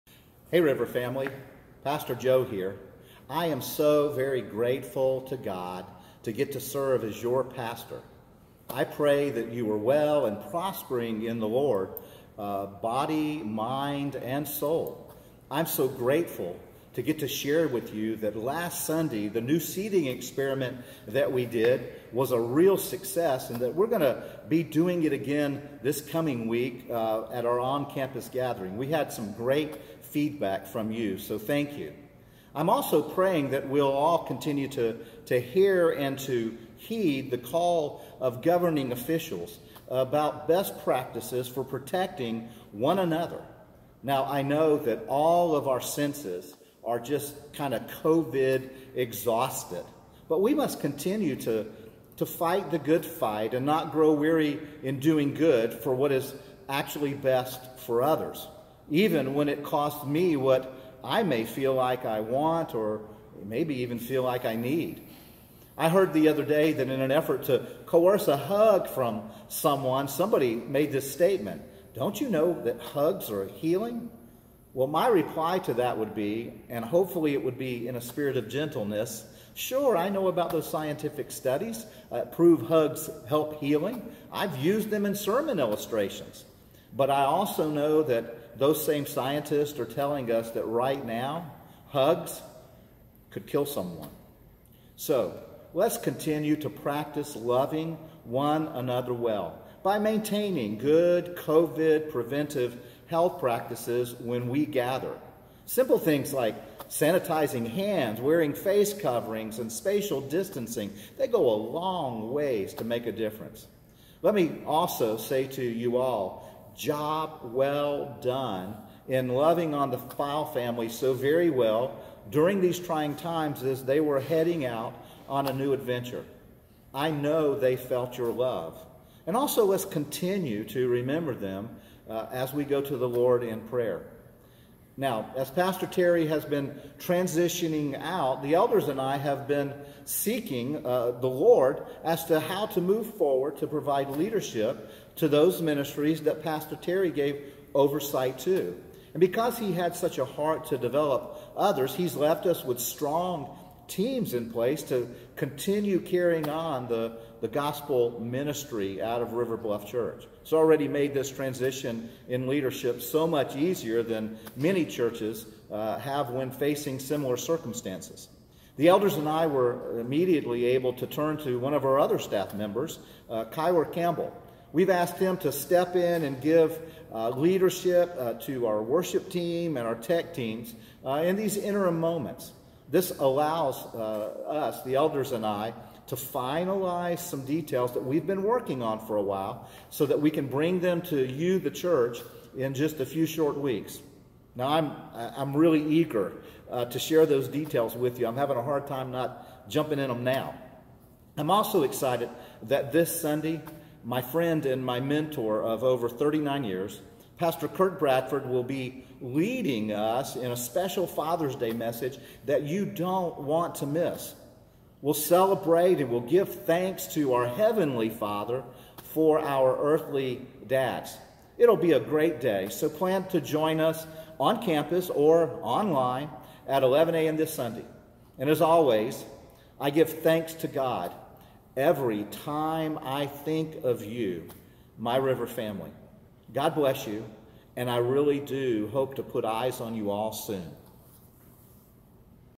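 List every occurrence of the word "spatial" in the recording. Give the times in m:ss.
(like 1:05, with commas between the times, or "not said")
1:49.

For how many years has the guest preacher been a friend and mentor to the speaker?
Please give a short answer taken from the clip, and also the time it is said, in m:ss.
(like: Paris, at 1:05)
39, at 3:26.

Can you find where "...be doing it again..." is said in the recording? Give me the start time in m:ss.
0:24.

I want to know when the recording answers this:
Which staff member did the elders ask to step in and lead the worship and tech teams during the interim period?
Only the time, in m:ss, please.
2:53.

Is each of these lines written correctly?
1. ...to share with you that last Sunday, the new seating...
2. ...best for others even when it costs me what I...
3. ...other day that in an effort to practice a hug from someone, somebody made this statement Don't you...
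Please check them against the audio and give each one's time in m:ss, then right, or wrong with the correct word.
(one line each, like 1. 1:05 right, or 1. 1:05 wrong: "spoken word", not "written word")
1. 0:17 right
2. 0:57 right
3. 1:06 wrong: "coerce", not "practice".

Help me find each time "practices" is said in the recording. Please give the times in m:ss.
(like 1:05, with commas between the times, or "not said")
0:40, 1:36, 1:43.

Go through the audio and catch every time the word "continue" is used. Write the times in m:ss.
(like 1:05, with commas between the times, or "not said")
0:34, 0:50, 1:35, 2:09, 2:35.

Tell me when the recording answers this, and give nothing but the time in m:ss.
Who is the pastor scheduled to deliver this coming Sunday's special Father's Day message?
3:27.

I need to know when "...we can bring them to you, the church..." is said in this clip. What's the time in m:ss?
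3:10.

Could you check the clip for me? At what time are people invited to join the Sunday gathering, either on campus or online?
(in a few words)
11 a.m.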